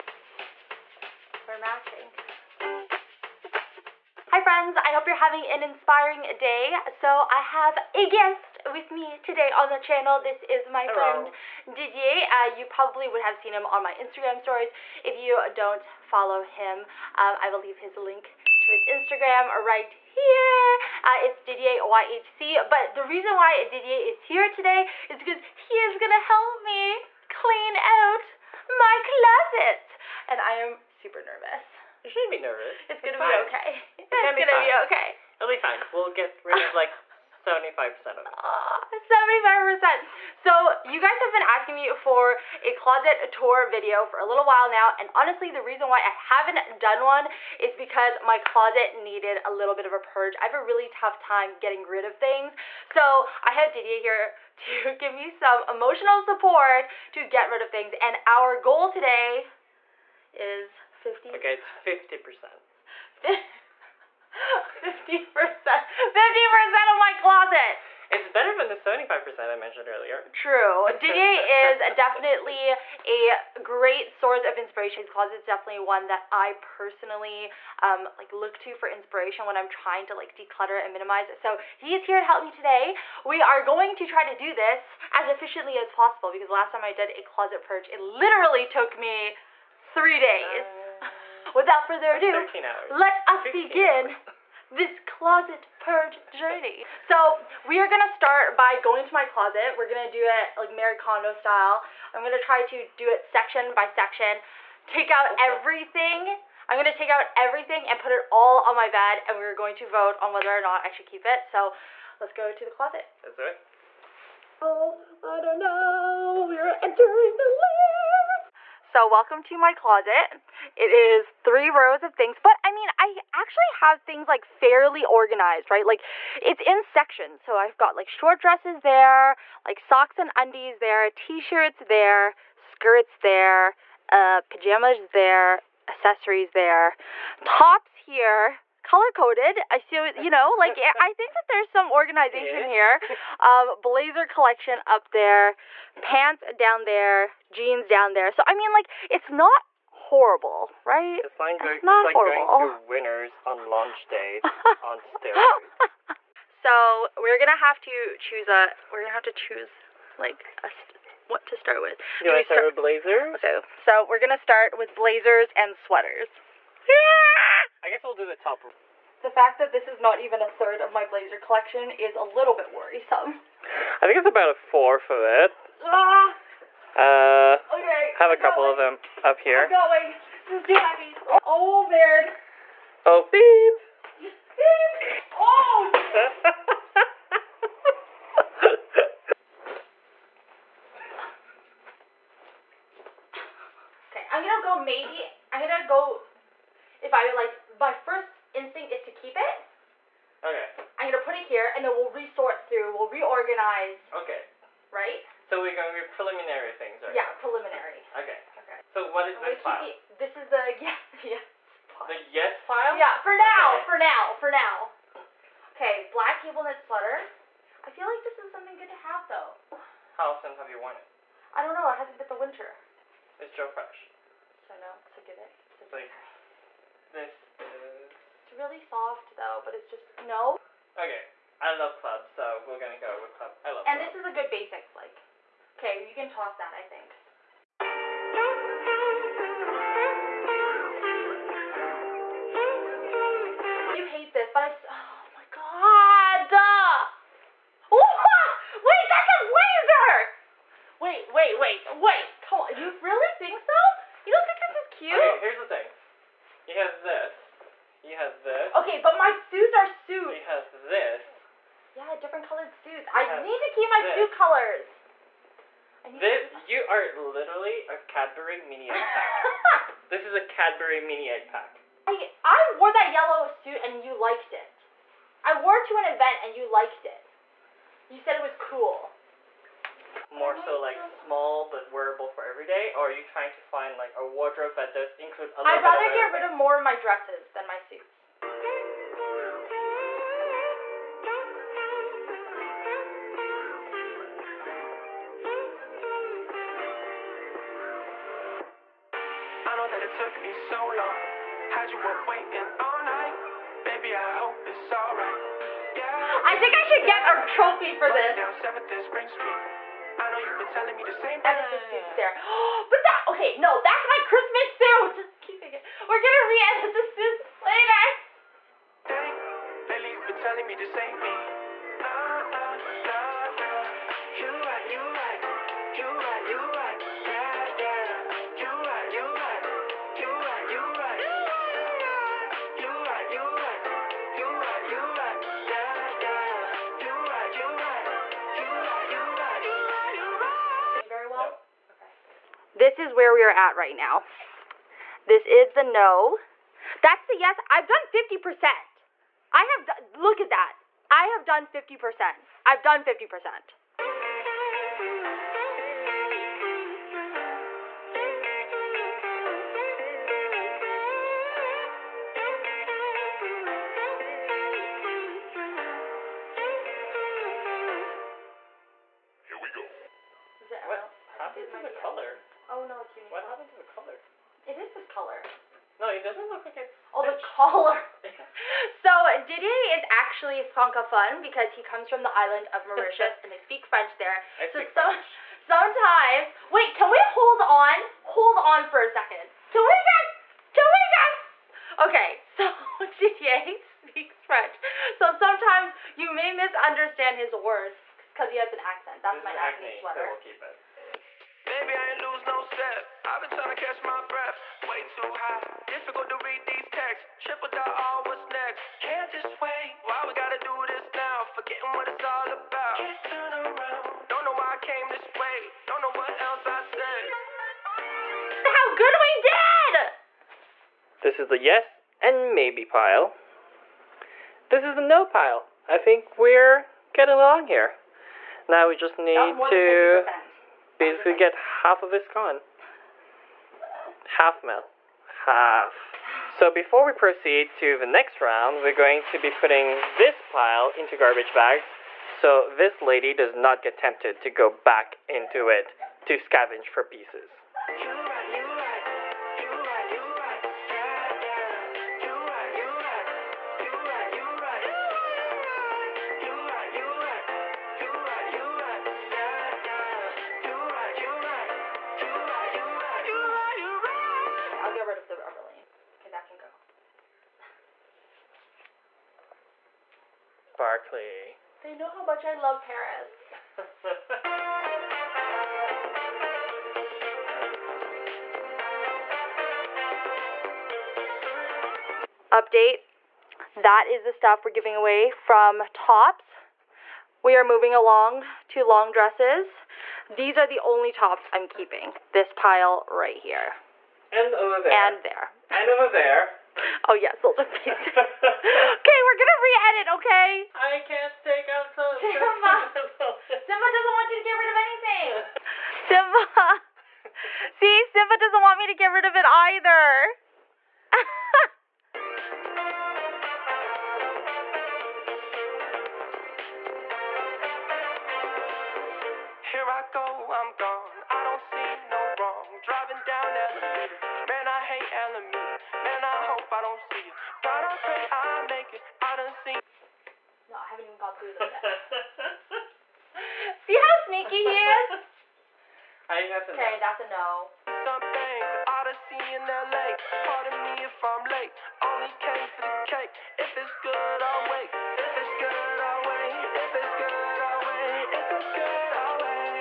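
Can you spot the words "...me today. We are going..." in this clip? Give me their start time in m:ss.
1:22.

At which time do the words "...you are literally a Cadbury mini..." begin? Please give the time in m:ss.
4:26.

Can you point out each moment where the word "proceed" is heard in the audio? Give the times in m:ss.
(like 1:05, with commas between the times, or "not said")
7:17.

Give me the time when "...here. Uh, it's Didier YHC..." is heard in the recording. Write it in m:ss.
0:19.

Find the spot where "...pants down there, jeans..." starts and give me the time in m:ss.
2:26.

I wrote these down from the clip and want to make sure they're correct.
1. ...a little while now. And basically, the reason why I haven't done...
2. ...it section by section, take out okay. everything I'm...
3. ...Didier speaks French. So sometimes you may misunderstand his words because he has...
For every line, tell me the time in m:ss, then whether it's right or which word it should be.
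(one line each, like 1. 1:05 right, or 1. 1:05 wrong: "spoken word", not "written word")
1. 0:44 wrong: "honestly", not "basically"
2. 1:43 right
3. 6:33 right.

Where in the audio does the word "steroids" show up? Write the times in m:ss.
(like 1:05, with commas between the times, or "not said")
2:35.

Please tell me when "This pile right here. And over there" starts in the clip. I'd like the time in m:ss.
8:12.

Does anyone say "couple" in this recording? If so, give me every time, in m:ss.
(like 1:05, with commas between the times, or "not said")
2:58.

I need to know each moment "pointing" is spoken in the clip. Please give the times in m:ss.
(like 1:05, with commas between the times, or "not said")
not said.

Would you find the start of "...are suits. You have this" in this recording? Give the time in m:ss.
4:19.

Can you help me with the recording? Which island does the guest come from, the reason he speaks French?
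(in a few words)
Mauritius.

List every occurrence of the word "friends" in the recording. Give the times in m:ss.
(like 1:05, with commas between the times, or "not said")
0:04, 0:10.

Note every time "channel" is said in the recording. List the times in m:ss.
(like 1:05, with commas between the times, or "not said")
0:09.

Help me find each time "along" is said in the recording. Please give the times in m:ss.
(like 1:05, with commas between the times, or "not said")
7:07, 8:07.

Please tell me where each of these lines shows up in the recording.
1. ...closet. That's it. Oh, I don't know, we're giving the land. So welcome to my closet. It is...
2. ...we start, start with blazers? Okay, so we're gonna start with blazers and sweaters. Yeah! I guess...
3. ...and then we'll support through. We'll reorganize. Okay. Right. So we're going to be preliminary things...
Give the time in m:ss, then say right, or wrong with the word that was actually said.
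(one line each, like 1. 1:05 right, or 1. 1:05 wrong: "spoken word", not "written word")
1. 1:52 wrong: "entering", not "giving"
2. 2:42 right
3. 3:21 wrong: "resort", not "support".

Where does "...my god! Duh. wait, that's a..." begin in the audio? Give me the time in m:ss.
4:05.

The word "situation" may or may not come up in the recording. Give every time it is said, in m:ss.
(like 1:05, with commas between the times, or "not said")
not said.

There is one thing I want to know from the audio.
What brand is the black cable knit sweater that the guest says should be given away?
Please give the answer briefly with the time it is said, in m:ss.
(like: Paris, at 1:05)
Joe Fresh, at 3:43.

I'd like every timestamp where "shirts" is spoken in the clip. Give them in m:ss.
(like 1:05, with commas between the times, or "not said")
2:11.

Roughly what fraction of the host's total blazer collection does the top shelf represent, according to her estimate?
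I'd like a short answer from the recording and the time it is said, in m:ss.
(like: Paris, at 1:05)
A fourth, at 2:54.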